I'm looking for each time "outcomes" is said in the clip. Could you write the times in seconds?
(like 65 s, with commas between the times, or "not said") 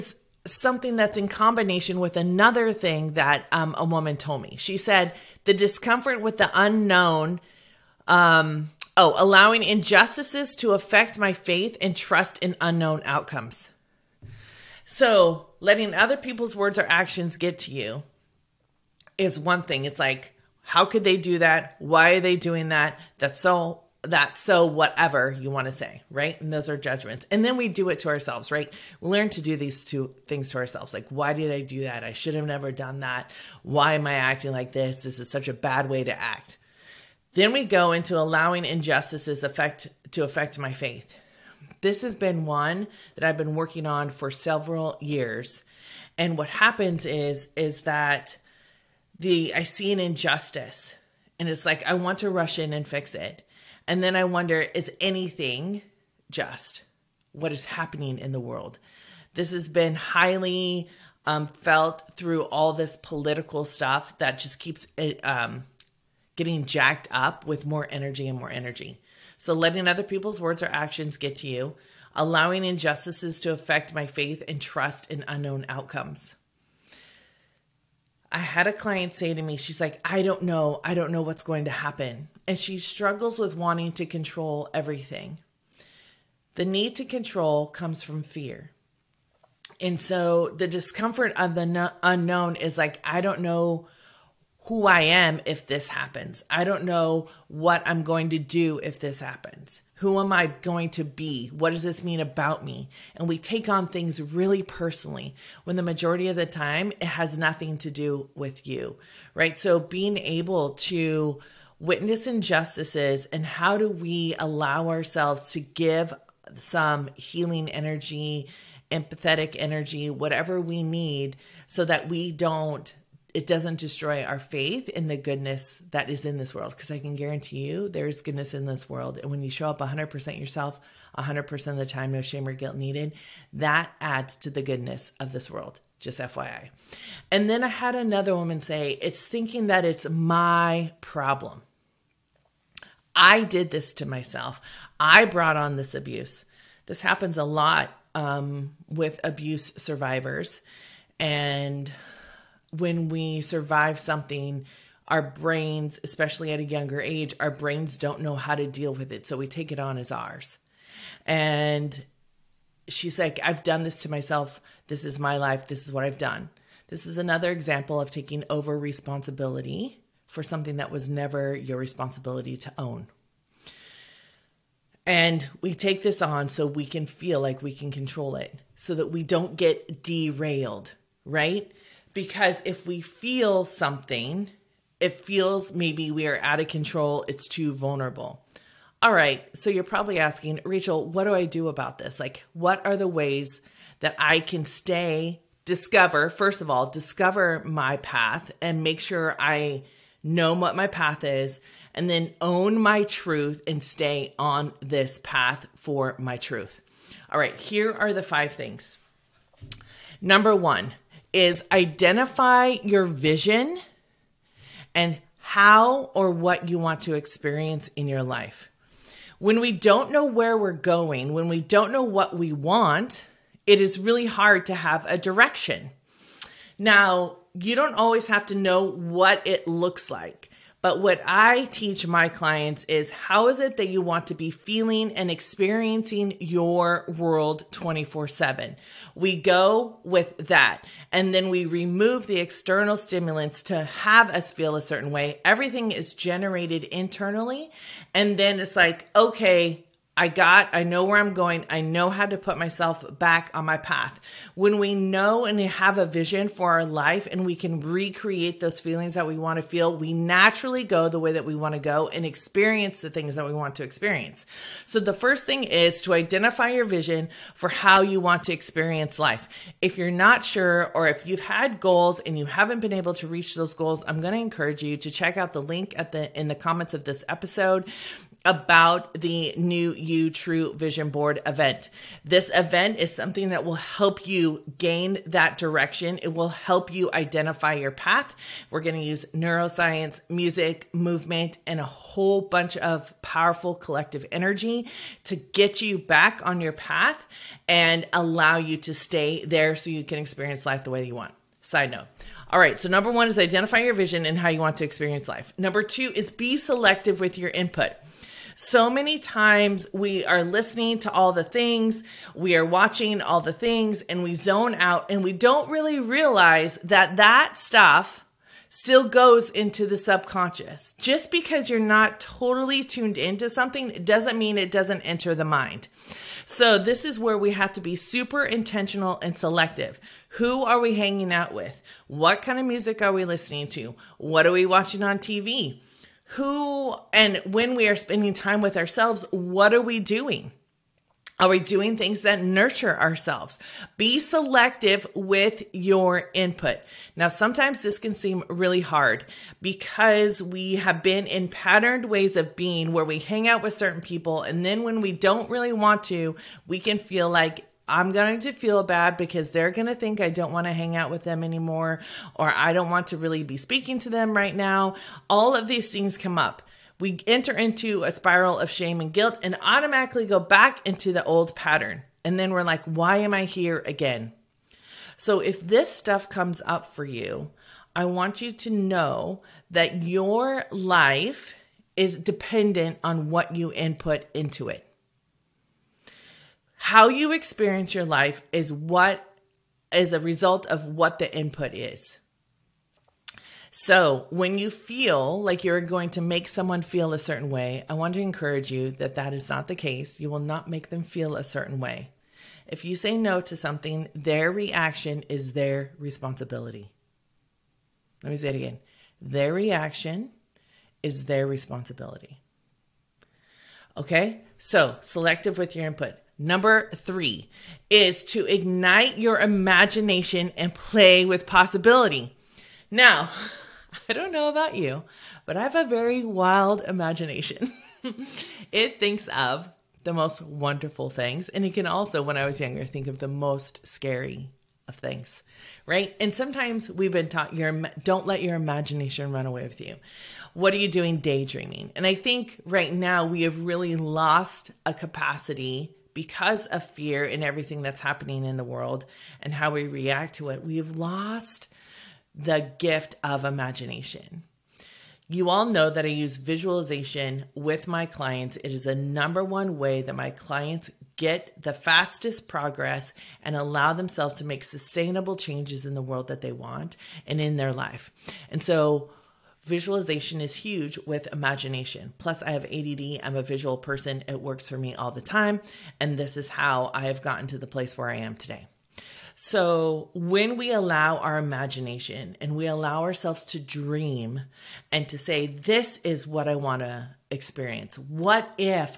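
13 s, 75 s.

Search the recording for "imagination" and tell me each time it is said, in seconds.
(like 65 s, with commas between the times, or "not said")
419 s, 426 s, 438 s, 453 s, 471 s, 481 s.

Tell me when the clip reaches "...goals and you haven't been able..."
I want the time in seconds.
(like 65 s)
271 s.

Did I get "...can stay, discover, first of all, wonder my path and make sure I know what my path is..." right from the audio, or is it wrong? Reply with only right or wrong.
wrong.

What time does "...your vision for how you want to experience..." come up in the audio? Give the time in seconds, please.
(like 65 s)
266 s.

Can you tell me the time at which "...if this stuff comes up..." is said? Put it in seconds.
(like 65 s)
375 s.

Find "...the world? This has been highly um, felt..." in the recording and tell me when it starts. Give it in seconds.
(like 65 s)
58 s.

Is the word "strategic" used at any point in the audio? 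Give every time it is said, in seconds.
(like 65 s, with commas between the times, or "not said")
not said.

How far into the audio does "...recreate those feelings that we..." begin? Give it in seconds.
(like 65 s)
257 s.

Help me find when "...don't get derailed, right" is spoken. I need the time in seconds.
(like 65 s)
179 s.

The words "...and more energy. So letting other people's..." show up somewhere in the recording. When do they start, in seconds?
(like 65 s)
68 s.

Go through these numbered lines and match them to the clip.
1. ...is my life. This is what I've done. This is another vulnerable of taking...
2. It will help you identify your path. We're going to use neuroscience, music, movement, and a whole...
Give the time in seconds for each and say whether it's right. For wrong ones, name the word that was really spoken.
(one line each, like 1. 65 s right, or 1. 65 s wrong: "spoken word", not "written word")
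1. 165 s wrong: "example", not "vulnerable"
2. 286 s right.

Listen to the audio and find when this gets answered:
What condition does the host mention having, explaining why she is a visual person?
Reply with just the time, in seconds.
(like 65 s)
472 s.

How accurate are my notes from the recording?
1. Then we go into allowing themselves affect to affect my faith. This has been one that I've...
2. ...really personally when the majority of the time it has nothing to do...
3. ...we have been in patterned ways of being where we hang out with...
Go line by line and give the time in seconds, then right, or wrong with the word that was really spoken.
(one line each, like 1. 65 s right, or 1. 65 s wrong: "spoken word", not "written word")
1. 37 s wrong: "injustices", not "themselves"
2. 104 s right
3. 350 s right.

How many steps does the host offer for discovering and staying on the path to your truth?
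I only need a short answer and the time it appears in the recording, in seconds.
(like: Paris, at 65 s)
5, at 208 s.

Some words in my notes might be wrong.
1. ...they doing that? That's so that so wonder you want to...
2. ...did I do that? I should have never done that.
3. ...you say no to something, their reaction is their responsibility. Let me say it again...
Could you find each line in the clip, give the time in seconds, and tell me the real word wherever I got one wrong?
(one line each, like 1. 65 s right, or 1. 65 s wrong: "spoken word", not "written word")
1. 22 s wrong: "whatever", not "wonder"
2. 31 s right
3. 402 s right.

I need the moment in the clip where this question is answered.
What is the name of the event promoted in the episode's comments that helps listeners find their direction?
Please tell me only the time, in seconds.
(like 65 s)
279 s.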